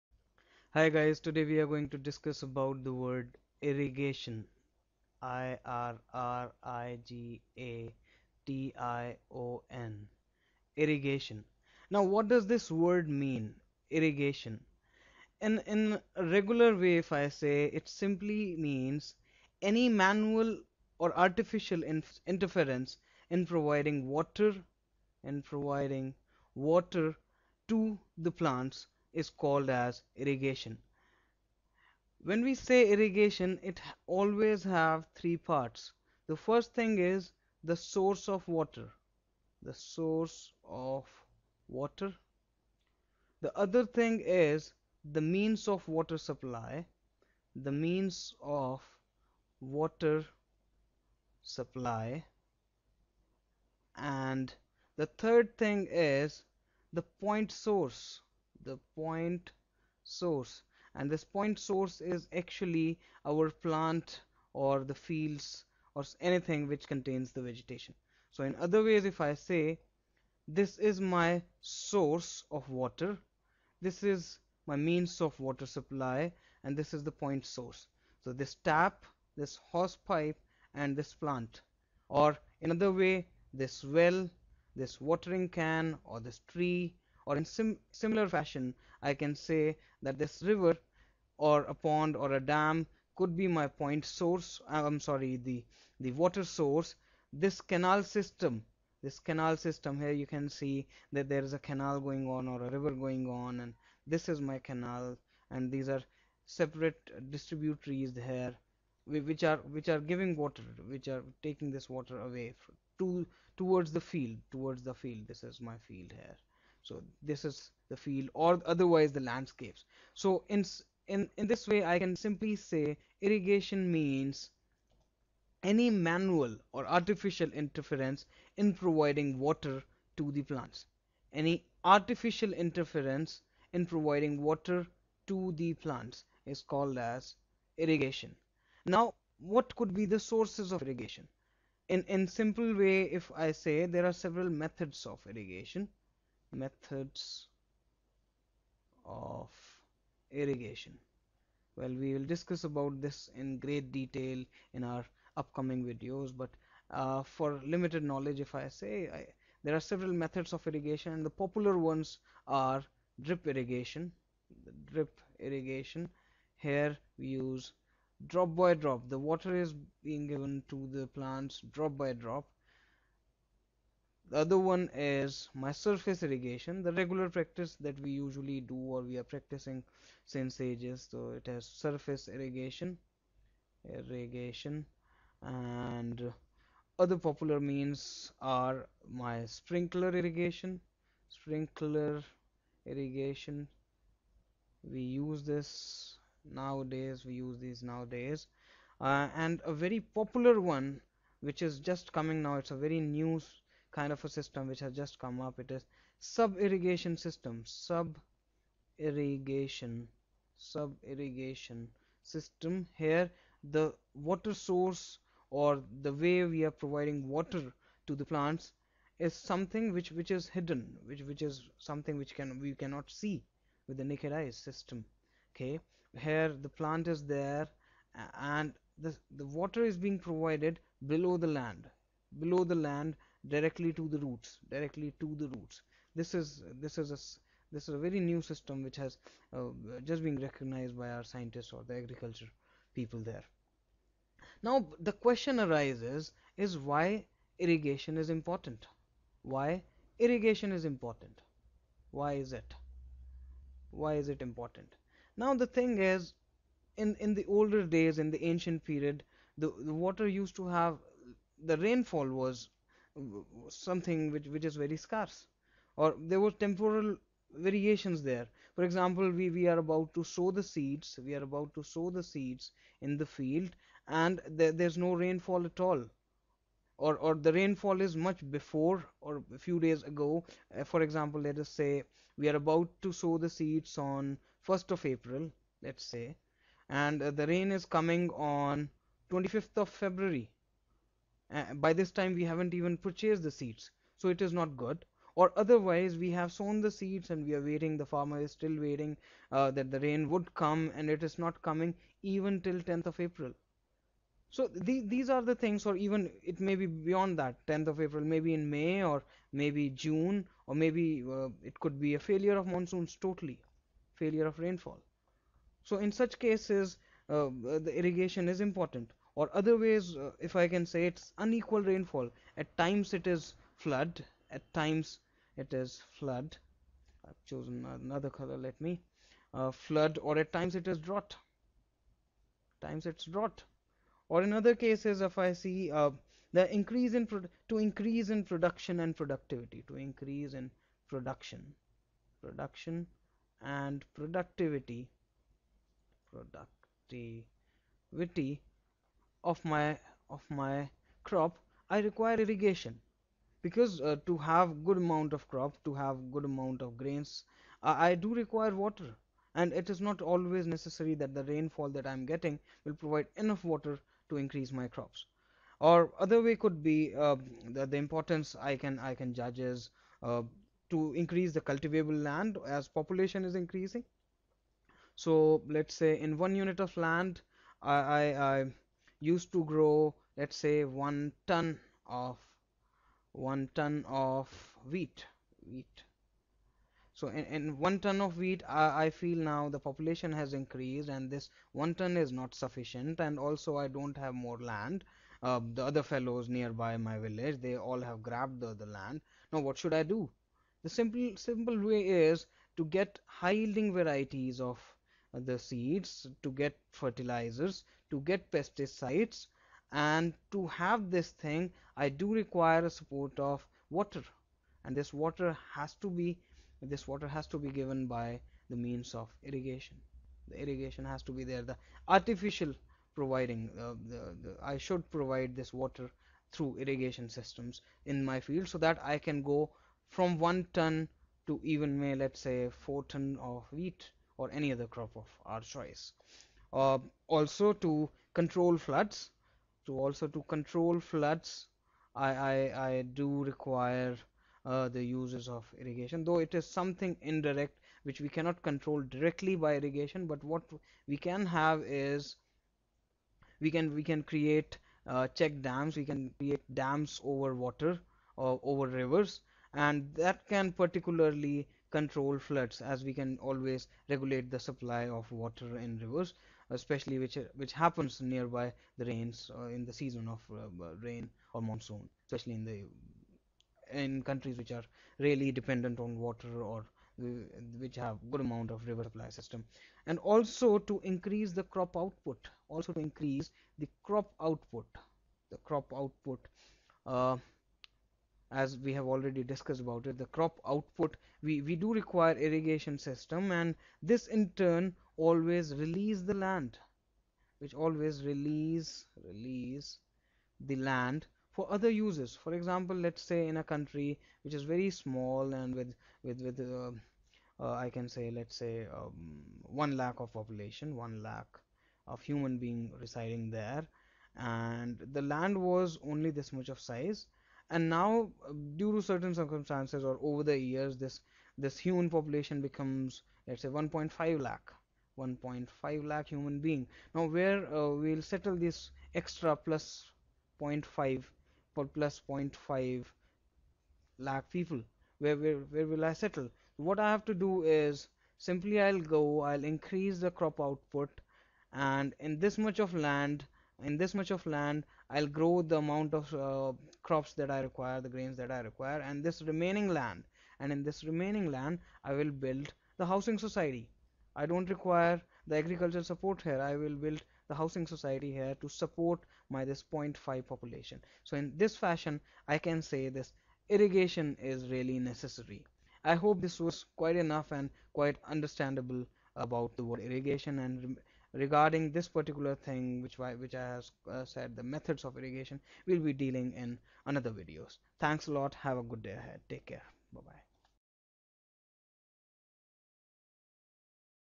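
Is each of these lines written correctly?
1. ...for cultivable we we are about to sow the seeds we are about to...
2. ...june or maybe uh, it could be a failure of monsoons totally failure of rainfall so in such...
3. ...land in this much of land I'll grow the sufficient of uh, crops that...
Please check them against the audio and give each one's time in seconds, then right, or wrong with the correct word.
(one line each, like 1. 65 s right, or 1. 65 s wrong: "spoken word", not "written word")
1. 268 s wrong: "example", not "cultivable"
2. 309 s right
3. 542 s wrong: "amount", not "sufficient".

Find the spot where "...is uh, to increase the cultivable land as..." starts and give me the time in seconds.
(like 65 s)
369 s.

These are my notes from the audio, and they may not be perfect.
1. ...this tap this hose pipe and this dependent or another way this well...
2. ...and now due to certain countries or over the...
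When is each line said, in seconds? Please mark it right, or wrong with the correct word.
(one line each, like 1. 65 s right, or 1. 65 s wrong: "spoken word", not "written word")
1. 78 s wrong: "plant", not "dependent"
2. 517 s wrong: "circumstances", not "countries".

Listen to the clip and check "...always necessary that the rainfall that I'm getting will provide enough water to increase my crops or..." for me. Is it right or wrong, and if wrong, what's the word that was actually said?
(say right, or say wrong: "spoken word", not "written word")
right.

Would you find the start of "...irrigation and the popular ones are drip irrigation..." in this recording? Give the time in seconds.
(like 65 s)
160 s.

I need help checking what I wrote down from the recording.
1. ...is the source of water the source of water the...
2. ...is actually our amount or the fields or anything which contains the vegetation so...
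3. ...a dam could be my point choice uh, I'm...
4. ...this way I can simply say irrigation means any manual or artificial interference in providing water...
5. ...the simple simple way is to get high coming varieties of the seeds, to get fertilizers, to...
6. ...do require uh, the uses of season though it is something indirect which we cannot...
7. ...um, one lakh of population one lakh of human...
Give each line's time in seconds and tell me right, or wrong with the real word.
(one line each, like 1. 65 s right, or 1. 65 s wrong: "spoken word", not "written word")
1. 36 s right
2. 62 s wrong: "plant", not "amount"
3. 92 s wrong: "source", not "choice"
4. 121 s right
5. 400 s wrong: "yielding", not "coming"
6. 443 s wrong: "irrigation", not "season"
7. 508 s right.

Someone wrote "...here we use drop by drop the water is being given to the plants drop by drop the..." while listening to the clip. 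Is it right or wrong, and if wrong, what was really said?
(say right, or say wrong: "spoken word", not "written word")
right.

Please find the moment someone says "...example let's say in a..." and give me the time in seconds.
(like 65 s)
502 s.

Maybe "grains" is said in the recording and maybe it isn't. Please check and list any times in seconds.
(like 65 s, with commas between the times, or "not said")
356 s, 548 s.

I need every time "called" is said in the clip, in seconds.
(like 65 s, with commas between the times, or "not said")
29 s, 136 s.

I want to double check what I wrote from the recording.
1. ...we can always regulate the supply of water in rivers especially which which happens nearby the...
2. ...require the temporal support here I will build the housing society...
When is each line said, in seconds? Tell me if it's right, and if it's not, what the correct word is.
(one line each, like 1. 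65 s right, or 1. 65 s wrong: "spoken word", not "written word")
1. 463 s right
2. 554 s wrong: "agricultural", not "temporal".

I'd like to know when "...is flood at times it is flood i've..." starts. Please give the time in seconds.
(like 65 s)
323 s.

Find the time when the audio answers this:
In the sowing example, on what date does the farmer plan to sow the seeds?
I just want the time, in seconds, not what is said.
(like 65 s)
284 s.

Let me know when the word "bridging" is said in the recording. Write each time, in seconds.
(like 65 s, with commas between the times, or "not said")
not said.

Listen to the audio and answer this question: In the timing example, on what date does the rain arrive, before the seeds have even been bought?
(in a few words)
25th of February.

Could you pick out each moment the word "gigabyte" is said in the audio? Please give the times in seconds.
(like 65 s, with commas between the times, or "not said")
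not said.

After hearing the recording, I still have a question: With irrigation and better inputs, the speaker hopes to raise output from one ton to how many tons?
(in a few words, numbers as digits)
4.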